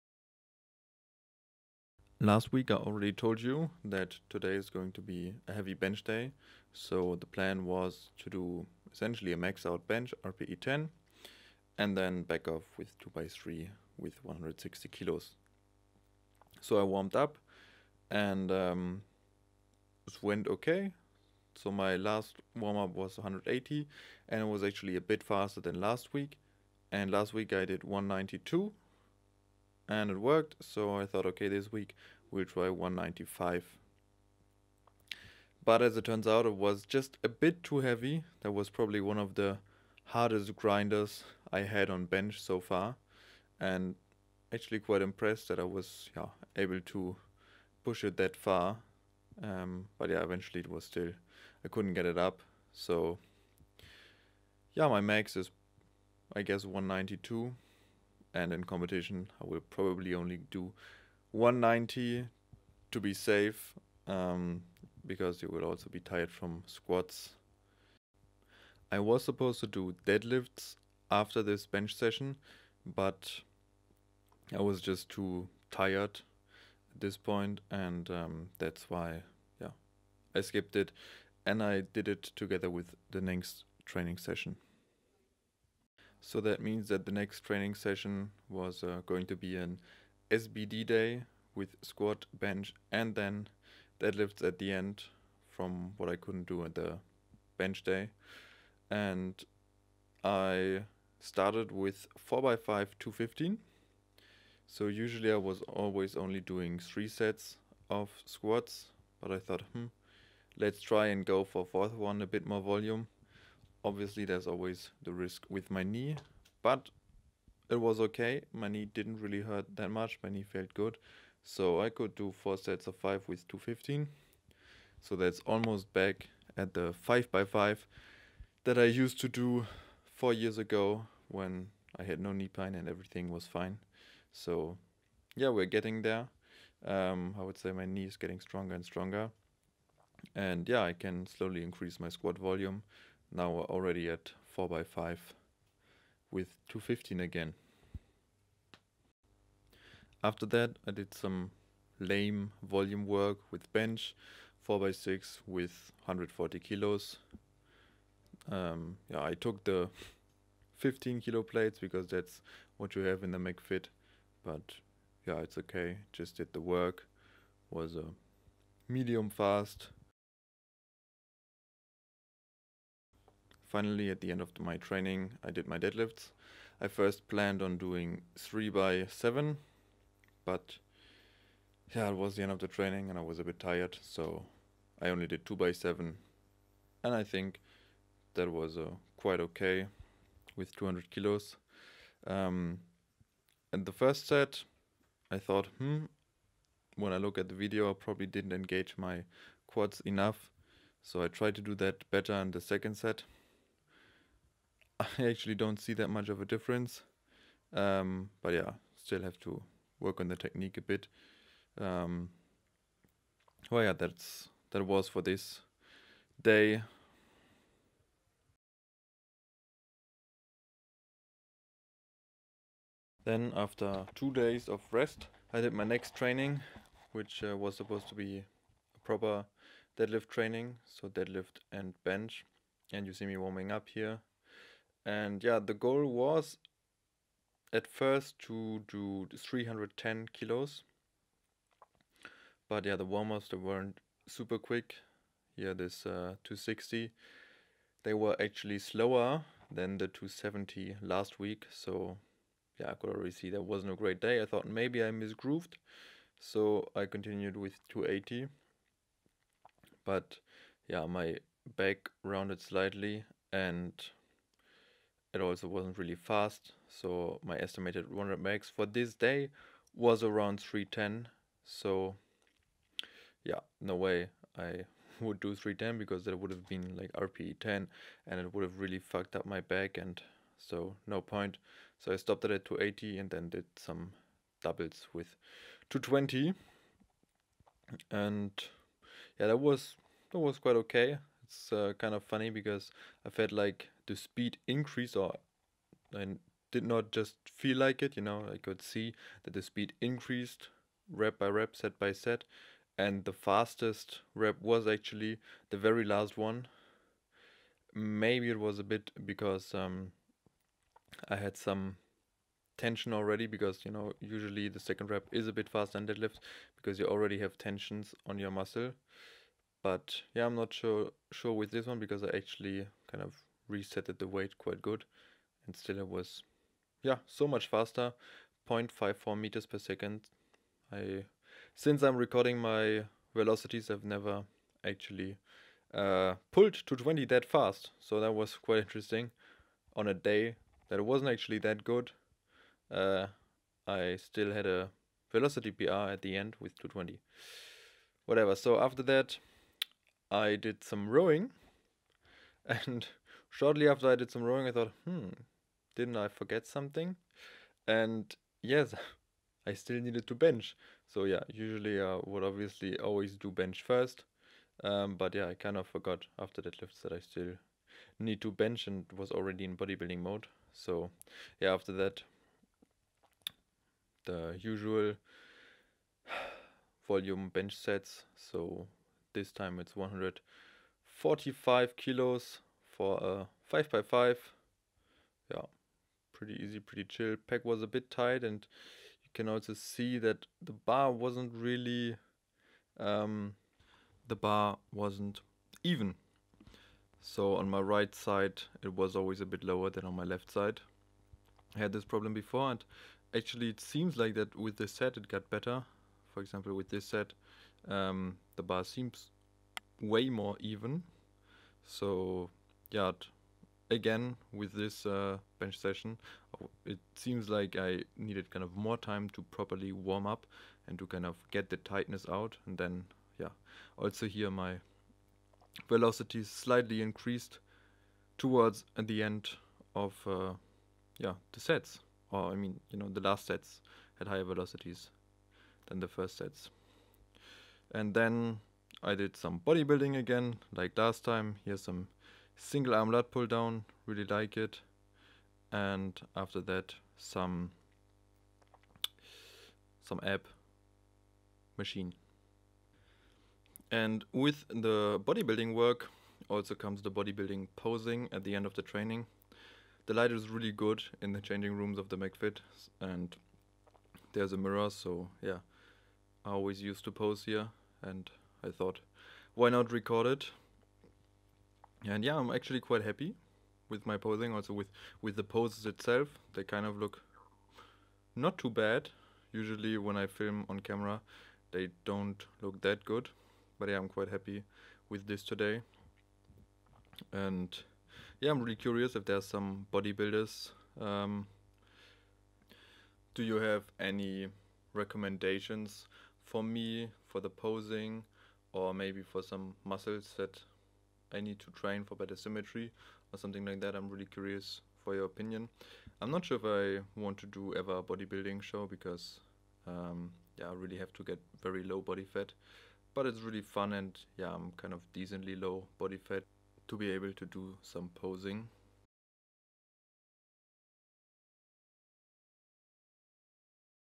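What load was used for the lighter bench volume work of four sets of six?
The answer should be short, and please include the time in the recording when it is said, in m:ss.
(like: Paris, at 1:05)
140 kilos, at 2:36.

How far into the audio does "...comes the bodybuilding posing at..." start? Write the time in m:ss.
7:36.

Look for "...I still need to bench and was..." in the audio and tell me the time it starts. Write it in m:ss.
6:07.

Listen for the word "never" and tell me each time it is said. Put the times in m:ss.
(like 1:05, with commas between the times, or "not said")
5:34.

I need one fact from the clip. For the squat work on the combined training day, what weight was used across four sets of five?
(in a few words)
215.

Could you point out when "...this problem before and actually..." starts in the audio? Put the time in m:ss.
6:41.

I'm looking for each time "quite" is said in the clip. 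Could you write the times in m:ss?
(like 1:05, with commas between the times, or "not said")
0:44, 3:09, 4:50, 5:24, 5:38, 7:52, 8:04.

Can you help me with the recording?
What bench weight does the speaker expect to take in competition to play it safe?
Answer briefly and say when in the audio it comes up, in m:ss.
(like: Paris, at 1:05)
190, at 1:01.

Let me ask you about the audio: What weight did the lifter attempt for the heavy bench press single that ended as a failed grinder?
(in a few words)
195.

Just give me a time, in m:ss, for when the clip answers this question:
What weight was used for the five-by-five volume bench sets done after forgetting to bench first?
6:19.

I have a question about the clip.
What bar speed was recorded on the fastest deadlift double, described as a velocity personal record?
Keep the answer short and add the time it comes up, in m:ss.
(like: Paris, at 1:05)
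0.54 meters per second, at 5:28.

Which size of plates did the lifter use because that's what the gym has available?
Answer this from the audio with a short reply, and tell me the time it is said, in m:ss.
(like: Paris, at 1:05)
15 kilo, at 2:40.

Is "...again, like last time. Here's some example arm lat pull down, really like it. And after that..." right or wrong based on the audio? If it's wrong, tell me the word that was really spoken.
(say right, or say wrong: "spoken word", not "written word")
wrong: "single", not "example".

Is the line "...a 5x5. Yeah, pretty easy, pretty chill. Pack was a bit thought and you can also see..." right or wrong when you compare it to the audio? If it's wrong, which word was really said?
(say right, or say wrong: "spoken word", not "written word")
wrong: "tight", not "thought".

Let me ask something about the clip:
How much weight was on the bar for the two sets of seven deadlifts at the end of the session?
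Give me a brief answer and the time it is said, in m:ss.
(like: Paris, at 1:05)
200 kilos, at 3:10.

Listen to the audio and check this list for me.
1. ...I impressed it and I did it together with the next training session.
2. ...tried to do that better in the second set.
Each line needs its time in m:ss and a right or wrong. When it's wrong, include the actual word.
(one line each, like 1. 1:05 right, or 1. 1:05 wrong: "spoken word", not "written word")
1. 1:20 wrong: "skipped", not "impressed"
2. 3:21 right.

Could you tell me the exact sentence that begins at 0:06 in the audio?
So the plan was to do essentially a max out bench, RPE 10, and then back off with 2x3 with 160 kilos.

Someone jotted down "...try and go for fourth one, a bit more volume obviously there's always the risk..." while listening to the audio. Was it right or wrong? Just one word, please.
right.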